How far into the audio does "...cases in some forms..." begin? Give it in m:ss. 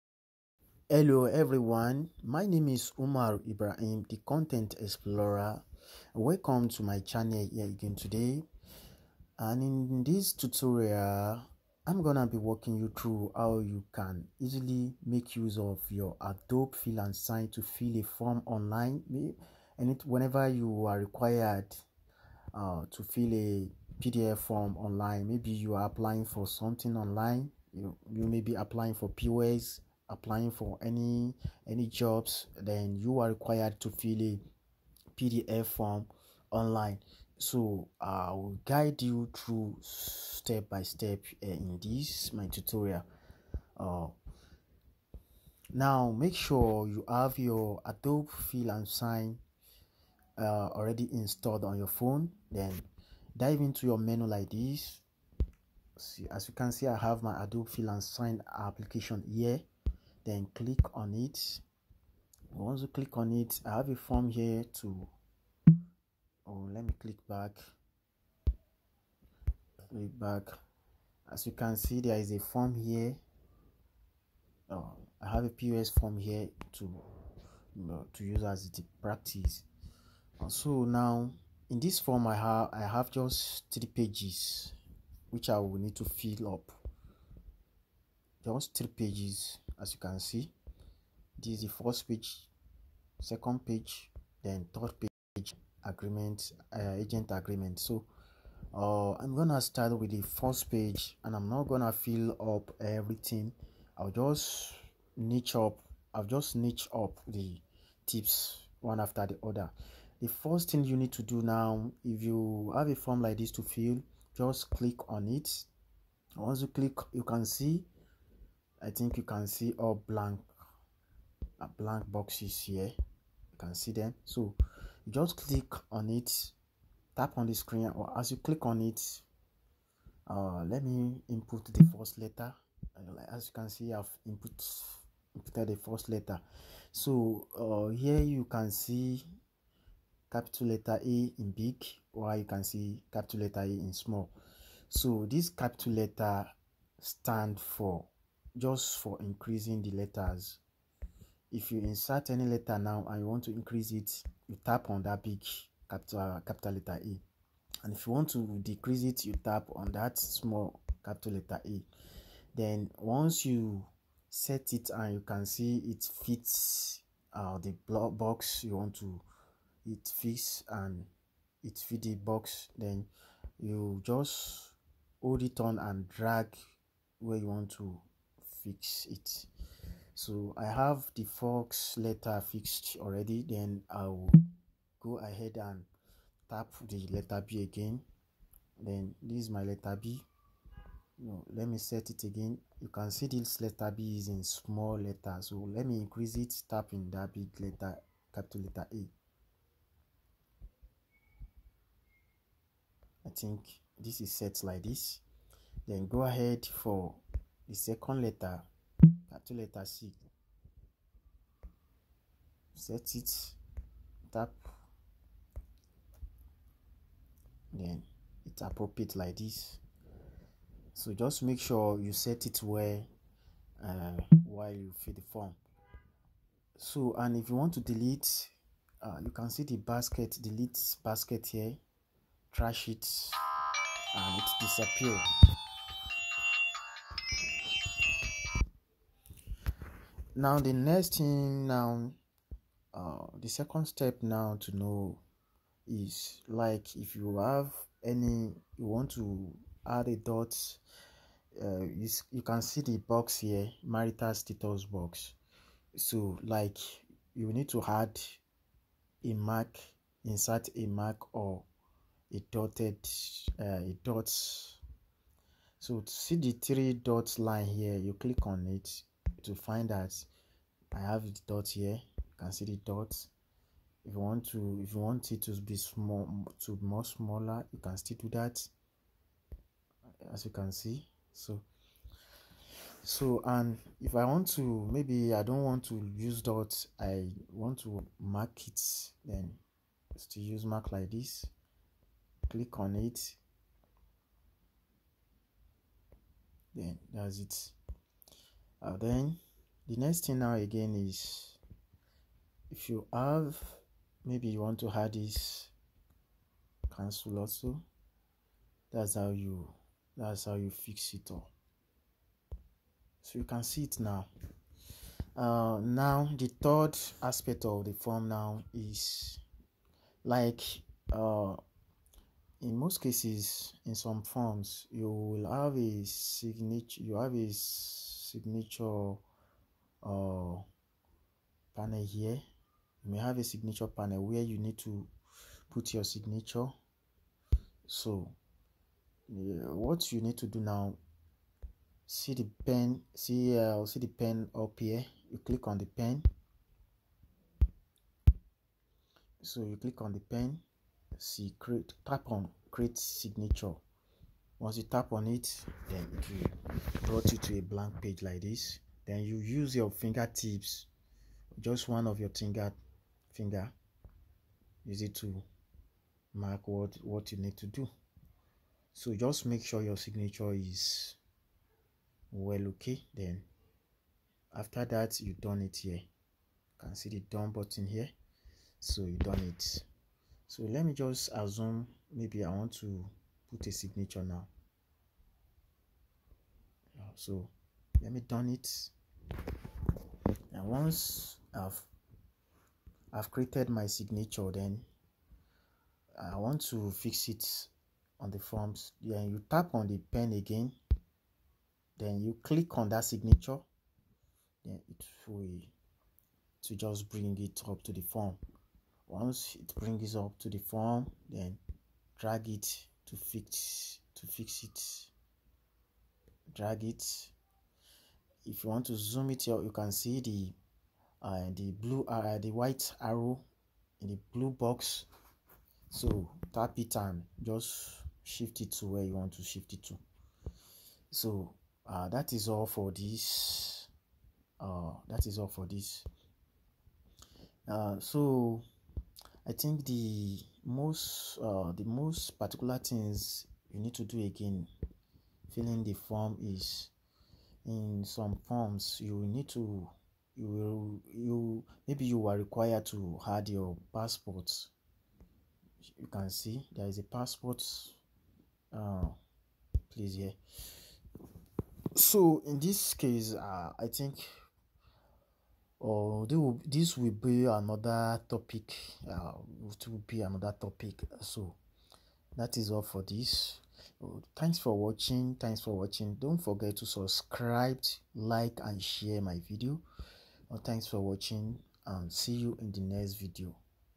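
5:23.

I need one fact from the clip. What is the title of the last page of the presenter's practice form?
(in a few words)
Agent agreement.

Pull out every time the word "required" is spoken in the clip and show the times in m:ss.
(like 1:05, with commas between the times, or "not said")
0:20, 0:33, 7:32.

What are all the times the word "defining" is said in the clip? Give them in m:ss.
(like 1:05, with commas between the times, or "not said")
not said.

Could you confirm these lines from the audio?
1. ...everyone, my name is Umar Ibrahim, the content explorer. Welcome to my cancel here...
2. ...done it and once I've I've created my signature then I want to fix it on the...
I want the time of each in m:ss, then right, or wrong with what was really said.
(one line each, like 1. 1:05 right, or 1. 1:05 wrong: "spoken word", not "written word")
1. 0:01 wrong: "channel", not "cancel"
2. 6:28 right.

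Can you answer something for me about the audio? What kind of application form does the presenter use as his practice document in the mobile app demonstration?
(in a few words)
POS form.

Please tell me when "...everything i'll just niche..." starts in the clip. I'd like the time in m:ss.
1:42.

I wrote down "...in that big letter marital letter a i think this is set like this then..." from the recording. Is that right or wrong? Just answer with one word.
wrong.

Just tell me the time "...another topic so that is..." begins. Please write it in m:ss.
7:50.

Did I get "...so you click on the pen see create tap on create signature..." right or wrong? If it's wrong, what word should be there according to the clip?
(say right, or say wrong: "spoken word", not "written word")
right.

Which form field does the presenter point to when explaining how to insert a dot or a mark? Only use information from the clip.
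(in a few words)
Marital status.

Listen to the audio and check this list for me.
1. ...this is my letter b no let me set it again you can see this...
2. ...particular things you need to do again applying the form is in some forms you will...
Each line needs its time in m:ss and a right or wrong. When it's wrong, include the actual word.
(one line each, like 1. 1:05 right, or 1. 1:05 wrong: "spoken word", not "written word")
1. 3:09 right
2. 7:22 wrong: "filling", not "applying".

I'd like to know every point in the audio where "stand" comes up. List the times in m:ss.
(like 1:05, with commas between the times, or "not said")
2:26.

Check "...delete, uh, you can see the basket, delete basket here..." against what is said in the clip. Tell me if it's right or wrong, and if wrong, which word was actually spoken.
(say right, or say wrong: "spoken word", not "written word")
right.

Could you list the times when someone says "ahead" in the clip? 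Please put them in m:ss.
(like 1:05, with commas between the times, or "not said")
3:05, 3:26.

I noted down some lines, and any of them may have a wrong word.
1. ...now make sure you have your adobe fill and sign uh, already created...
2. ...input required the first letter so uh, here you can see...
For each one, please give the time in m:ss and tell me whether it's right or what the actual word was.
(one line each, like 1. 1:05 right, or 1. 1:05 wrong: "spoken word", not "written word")
1. 0:45 wrong: "installed", not "created"
2. 2:14 wrong: "inputted", not "required".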